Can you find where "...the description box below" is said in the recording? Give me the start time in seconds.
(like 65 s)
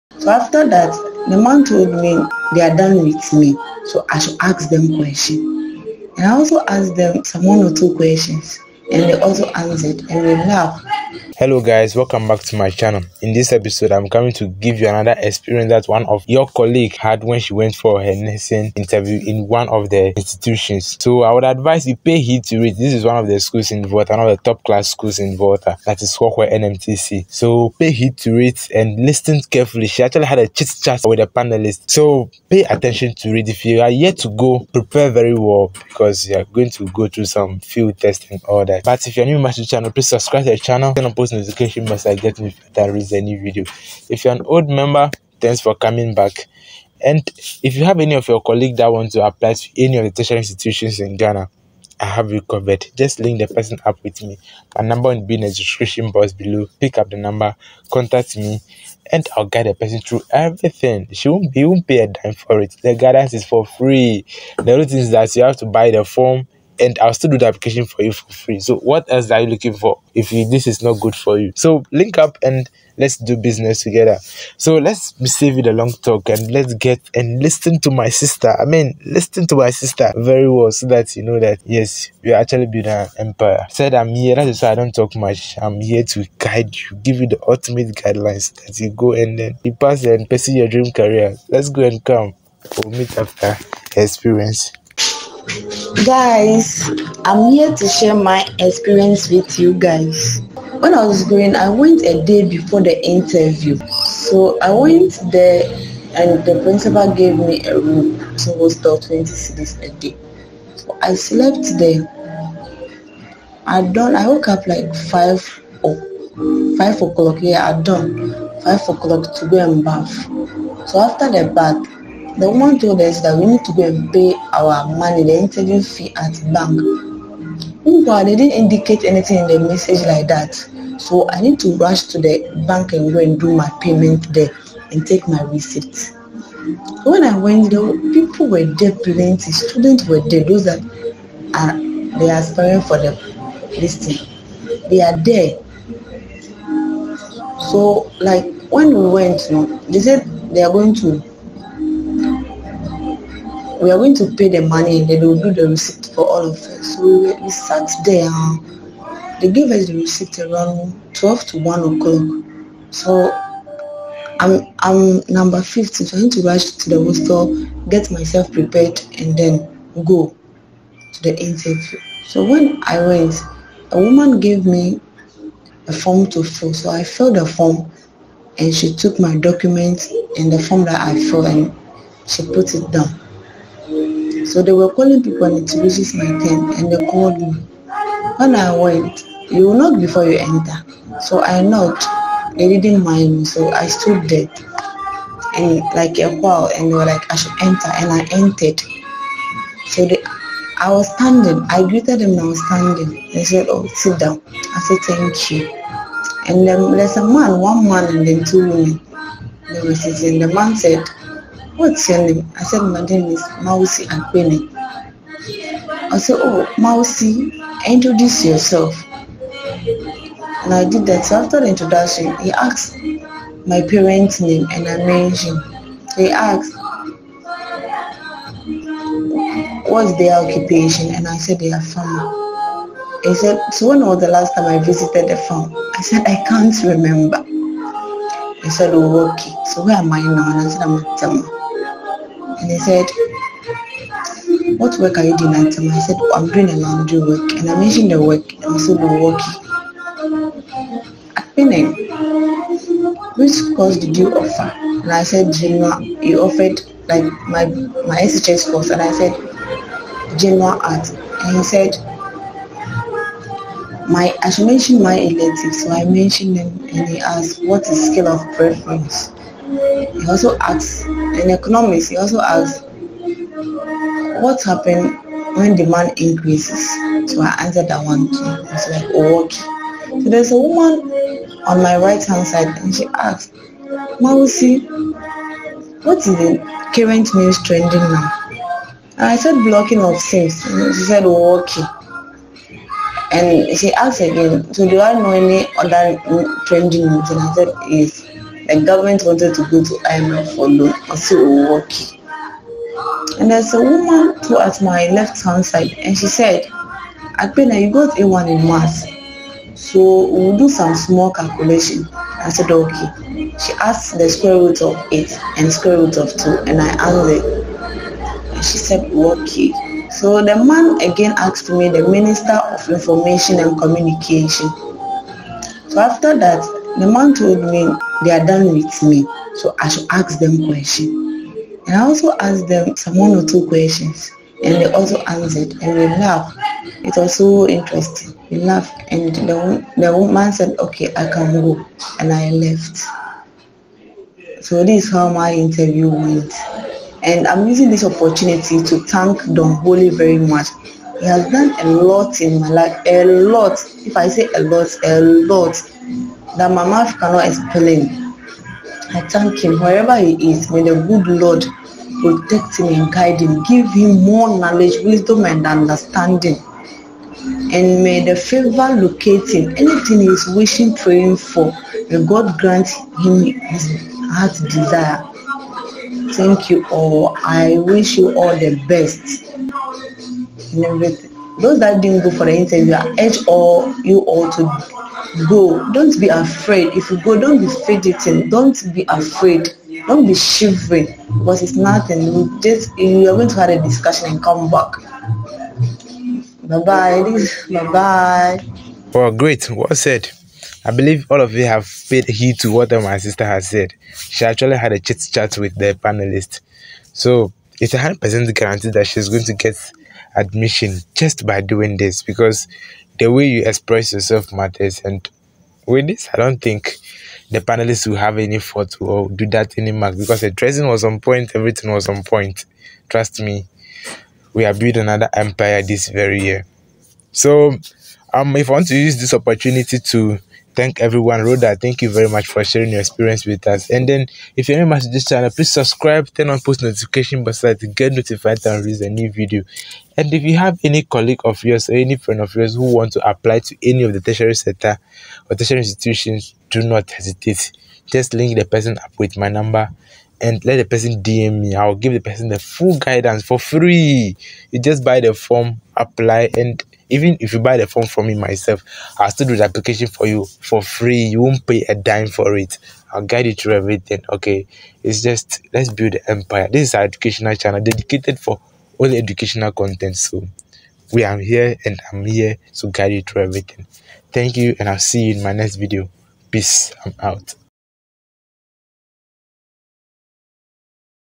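55 s.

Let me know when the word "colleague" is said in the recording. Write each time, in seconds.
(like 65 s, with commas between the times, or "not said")
16 s, 48 s, 441 s.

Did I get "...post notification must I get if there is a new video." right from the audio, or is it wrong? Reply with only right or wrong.
right.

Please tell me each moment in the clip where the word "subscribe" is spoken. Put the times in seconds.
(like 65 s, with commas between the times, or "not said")
40 s, 435 s.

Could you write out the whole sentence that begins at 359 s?
I thank him wherever he is.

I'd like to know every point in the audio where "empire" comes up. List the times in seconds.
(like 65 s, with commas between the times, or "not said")
83 s, 425 s, 466 s.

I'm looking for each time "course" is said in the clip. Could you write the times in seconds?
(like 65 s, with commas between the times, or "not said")
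253 s, 258 s.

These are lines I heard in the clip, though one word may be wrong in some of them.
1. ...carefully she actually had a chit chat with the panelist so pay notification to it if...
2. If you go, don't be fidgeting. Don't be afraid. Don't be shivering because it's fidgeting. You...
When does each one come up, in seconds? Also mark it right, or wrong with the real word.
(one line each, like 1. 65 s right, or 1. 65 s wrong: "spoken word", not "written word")
1. 29 s wrong: "attention", not "notification"
2. 386 s wrong: "nothing", not "fidgeting".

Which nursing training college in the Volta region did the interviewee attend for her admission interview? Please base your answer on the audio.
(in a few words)
Kwakwa NMTC.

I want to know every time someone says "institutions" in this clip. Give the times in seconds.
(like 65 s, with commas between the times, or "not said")
20 s, 50 s, 445 s.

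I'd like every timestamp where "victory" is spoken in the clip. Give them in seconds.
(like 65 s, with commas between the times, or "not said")
not said.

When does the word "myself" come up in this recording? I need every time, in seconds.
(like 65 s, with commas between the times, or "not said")
168 s, 458 s.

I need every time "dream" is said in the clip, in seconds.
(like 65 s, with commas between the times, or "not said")
90 s.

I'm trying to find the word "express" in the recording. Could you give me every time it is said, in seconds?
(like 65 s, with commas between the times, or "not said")
413 s.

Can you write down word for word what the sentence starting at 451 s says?
I'll give the person the full guidance for free.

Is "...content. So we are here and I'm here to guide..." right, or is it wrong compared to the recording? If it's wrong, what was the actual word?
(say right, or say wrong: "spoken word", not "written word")
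right.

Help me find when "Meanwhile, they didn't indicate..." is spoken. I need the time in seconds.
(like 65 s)
127 s.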